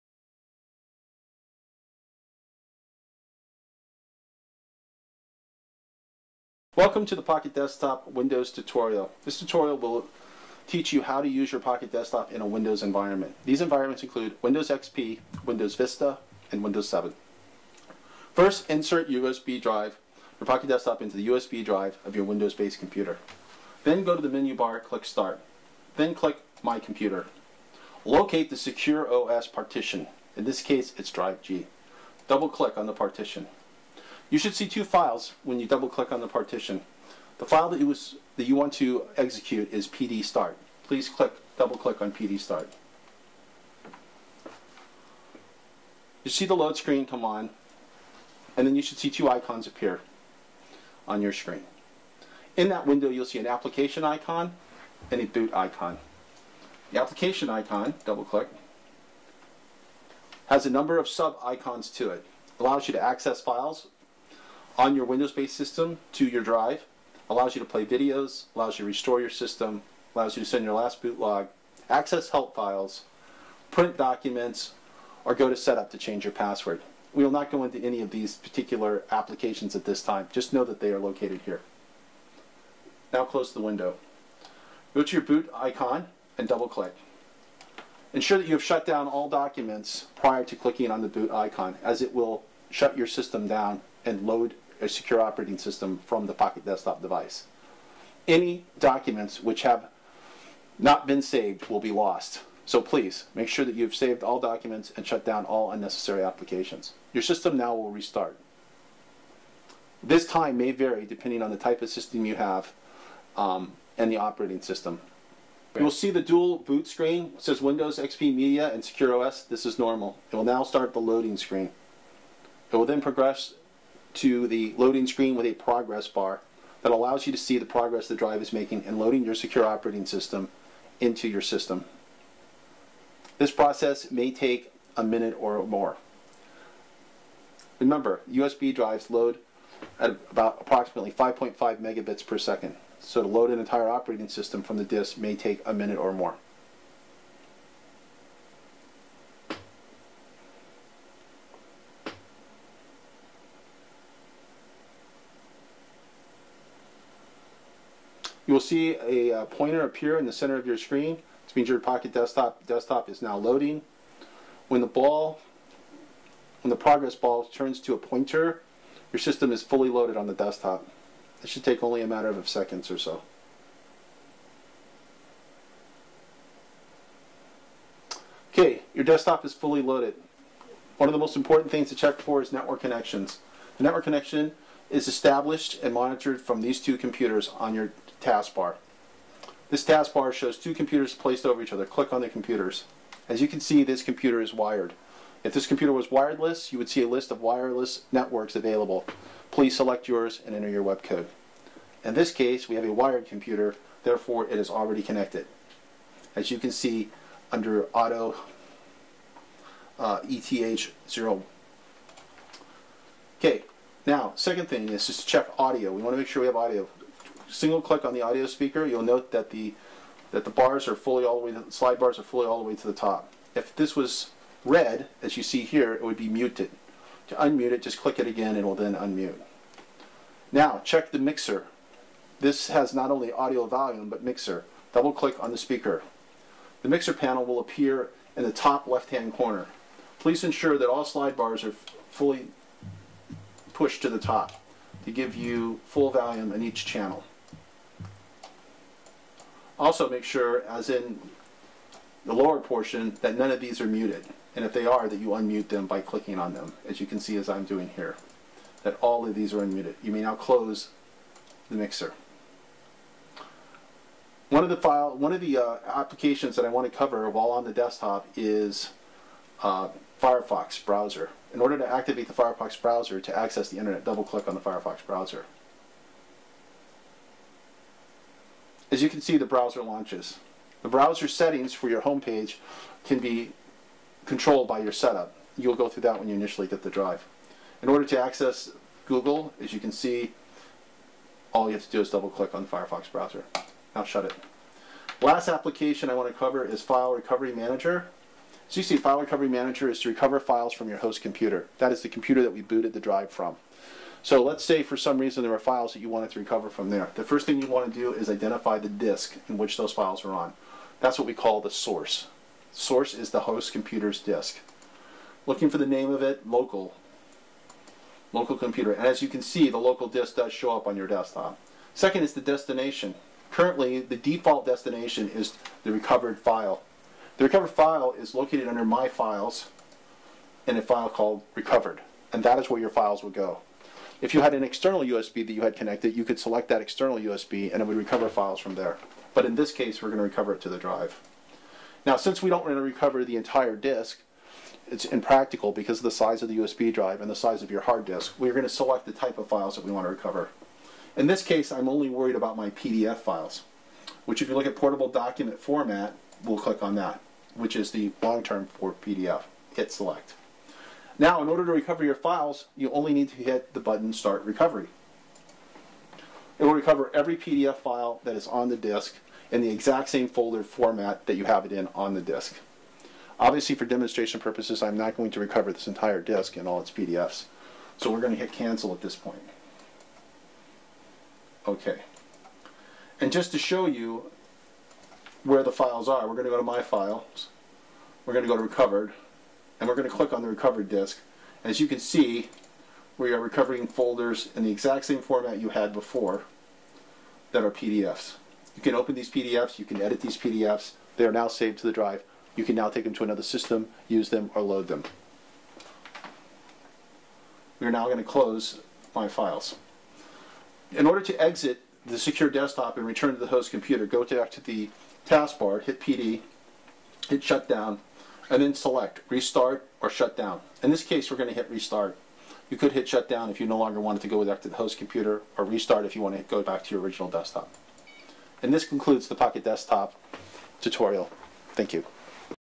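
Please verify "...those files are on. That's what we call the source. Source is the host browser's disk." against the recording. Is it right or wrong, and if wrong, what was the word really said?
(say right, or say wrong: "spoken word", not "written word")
wrong: "computer", not "browser".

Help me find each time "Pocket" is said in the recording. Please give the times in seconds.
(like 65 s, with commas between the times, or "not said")
7 s, 11 s, 20 s, 96 s, 161 s, 429 s.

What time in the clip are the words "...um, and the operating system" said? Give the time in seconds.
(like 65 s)
113 s.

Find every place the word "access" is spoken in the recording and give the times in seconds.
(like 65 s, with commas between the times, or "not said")
63 s, 71 s, 273 s, 288 s.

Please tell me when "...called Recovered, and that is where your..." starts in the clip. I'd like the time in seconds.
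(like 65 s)
331 s.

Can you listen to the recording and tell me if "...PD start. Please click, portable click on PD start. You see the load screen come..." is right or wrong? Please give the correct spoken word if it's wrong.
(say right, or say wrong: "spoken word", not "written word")
wrong: "double", not "portable".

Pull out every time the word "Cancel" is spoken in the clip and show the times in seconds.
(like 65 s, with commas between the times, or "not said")
378 s.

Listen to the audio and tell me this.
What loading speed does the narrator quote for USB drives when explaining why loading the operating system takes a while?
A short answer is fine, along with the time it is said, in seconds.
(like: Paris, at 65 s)
5.5 megabits per second, at 141 s.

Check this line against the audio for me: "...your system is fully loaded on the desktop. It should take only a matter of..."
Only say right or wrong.
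right.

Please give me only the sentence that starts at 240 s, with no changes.
Please ensure that all slide bars are fully pushed to the top to give you full volume in each channel.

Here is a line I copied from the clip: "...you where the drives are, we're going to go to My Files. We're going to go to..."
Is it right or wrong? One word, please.
wrong.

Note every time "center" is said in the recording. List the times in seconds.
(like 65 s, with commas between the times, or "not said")
160 s.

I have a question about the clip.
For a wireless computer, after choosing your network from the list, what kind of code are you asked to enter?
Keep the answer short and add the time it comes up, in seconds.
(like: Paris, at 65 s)
WEP code, at 200 s.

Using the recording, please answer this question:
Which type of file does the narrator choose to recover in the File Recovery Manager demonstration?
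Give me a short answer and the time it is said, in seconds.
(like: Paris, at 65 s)
PDF files, at 352 s.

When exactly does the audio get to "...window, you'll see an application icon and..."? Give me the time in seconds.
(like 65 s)
52 s.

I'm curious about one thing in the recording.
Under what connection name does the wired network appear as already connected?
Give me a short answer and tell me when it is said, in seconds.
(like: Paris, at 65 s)
ETH0, at 210 s.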